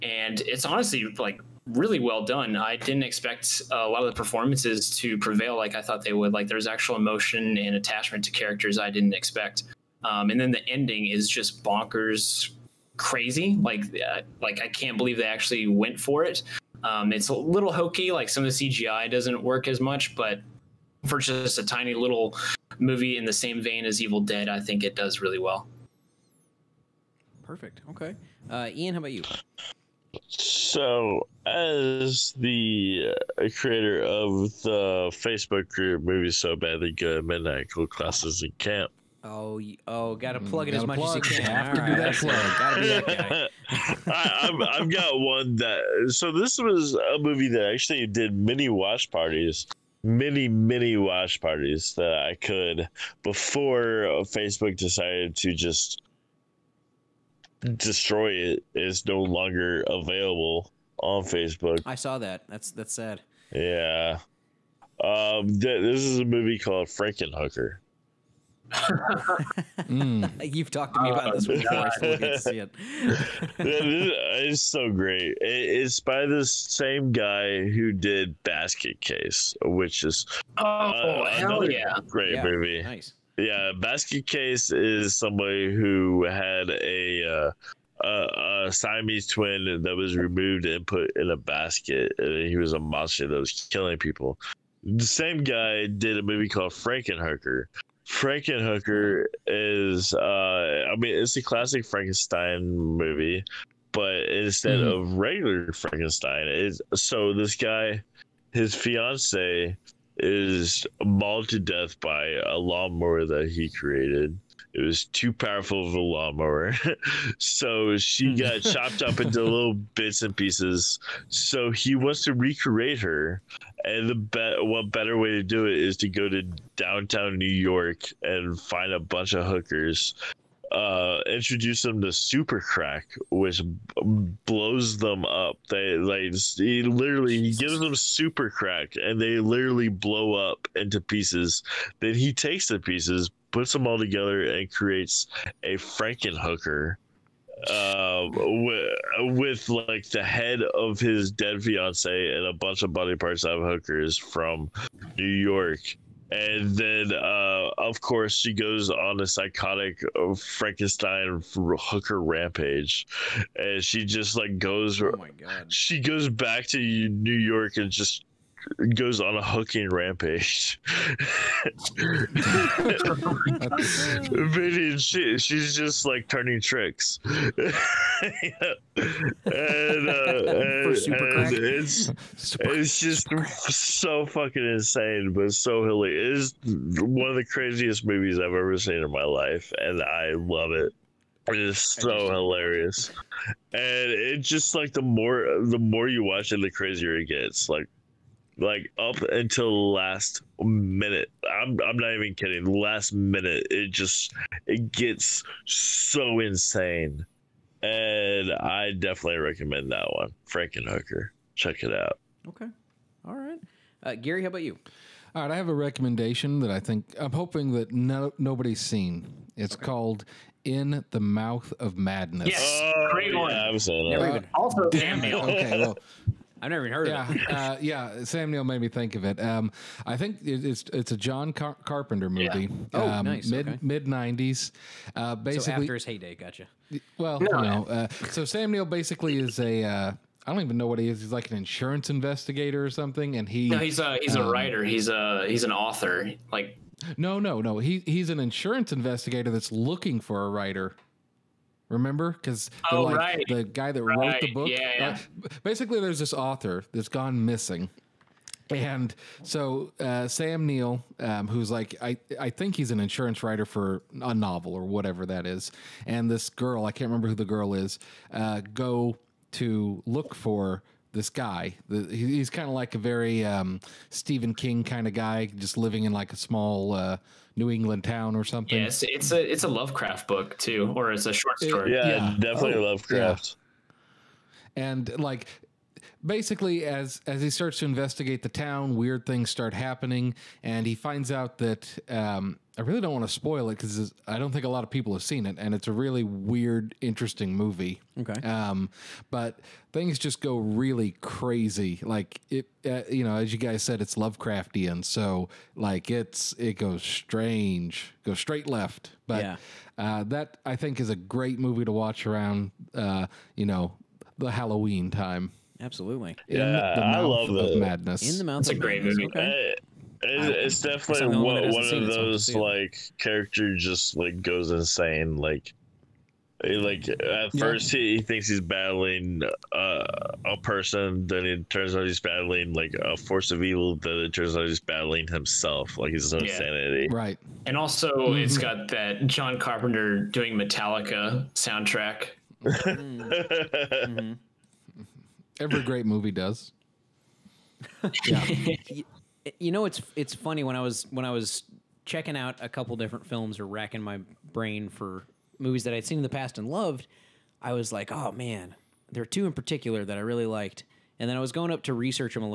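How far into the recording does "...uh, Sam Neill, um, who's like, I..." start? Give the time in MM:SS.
04:19.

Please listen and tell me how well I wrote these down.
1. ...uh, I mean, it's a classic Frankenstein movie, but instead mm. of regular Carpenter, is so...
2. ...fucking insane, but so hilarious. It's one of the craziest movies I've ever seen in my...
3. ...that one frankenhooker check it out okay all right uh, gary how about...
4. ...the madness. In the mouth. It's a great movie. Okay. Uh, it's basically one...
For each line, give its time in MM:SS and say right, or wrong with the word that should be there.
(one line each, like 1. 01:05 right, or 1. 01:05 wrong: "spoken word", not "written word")
1. 01:40 wrong: "Frankenstein", not "Carpenter"
2. 03:04 right
3. 03:29 right
4. 05:17 wrong: "definitely", not "basically".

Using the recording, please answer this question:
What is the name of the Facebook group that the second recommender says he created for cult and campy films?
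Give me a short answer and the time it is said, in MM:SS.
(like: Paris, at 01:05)
Movies So Badly Good, at 00:36.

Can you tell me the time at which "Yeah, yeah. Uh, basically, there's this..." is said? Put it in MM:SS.
04:14.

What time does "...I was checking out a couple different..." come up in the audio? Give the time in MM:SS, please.
05:51.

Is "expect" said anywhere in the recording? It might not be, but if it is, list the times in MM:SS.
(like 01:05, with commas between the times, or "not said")
00:03, 00:09.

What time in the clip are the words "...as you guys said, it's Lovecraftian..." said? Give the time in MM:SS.
05:03.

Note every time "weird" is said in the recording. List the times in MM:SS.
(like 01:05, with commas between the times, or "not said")
04:48, 04:56.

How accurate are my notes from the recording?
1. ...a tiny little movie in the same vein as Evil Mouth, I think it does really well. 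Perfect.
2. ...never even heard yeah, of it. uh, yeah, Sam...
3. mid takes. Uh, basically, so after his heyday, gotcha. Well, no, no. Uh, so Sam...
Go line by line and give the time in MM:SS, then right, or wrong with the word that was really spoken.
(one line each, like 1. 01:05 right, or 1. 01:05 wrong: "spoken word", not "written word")
1. 00:21 wrong: "Dead", not "Mouth"
2. 03:46 right
3. 03:53 wrong: "nineties", not "takes".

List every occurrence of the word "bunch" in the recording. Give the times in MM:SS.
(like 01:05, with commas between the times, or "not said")
02:08, 02:32.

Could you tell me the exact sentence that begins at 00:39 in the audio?
Oh, oh, gotta mm, plug it mm, as much plug.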